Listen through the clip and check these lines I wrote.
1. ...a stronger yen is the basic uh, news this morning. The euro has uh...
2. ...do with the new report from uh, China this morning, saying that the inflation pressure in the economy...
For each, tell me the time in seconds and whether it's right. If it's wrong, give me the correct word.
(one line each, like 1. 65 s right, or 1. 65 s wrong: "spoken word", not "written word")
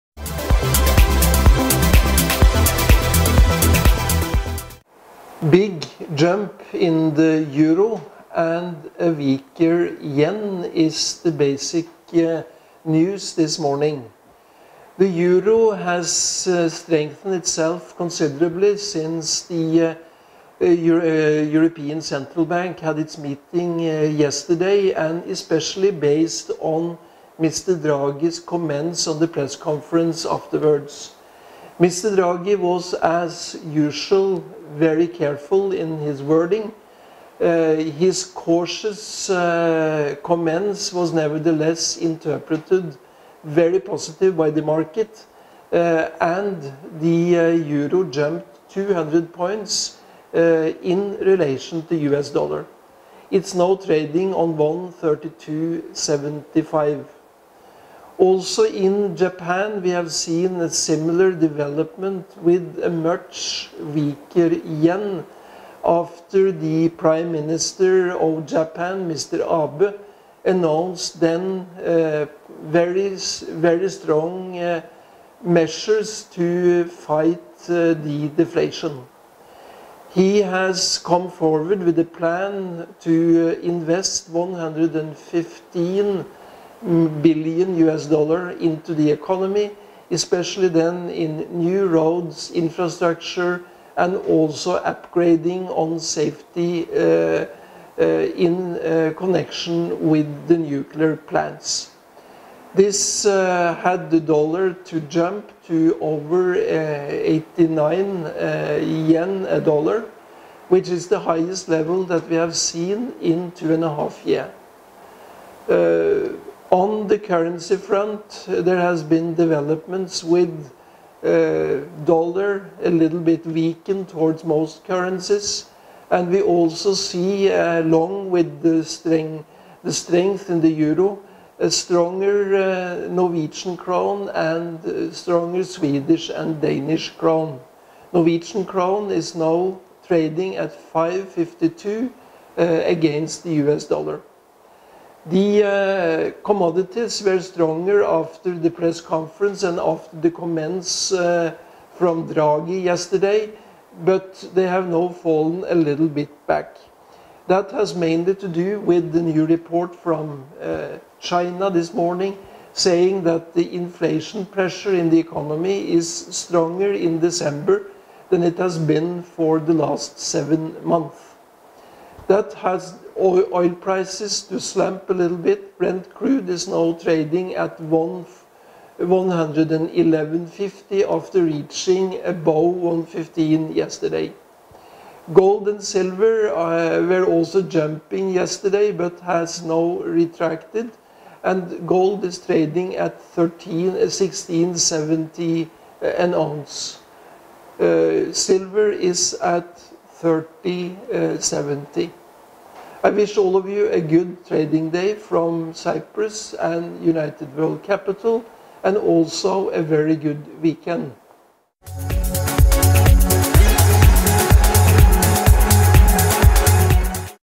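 1. 8 s wrong: "weaker", not "stronger"
2. 158 s right.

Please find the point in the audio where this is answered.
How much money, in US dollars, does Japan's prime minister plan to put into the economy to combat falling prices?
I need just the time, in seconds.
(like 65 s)
84 s.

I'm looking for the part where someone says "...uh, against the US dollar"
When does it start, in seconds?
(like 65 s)
142 s.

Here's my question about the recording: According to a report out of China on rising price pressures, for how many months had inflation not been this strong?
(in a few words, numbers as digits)
7.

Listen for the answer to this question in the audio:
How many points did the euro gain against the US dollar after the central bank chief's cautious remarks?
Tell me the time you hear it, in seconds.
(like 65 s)
48 s.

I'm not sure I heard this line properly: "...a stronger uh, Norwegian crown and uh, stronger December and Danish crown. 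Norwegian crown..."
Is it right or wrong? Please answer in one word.
wrong.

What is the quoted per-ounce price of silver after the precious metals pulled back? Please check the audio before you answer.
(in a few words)
30.70.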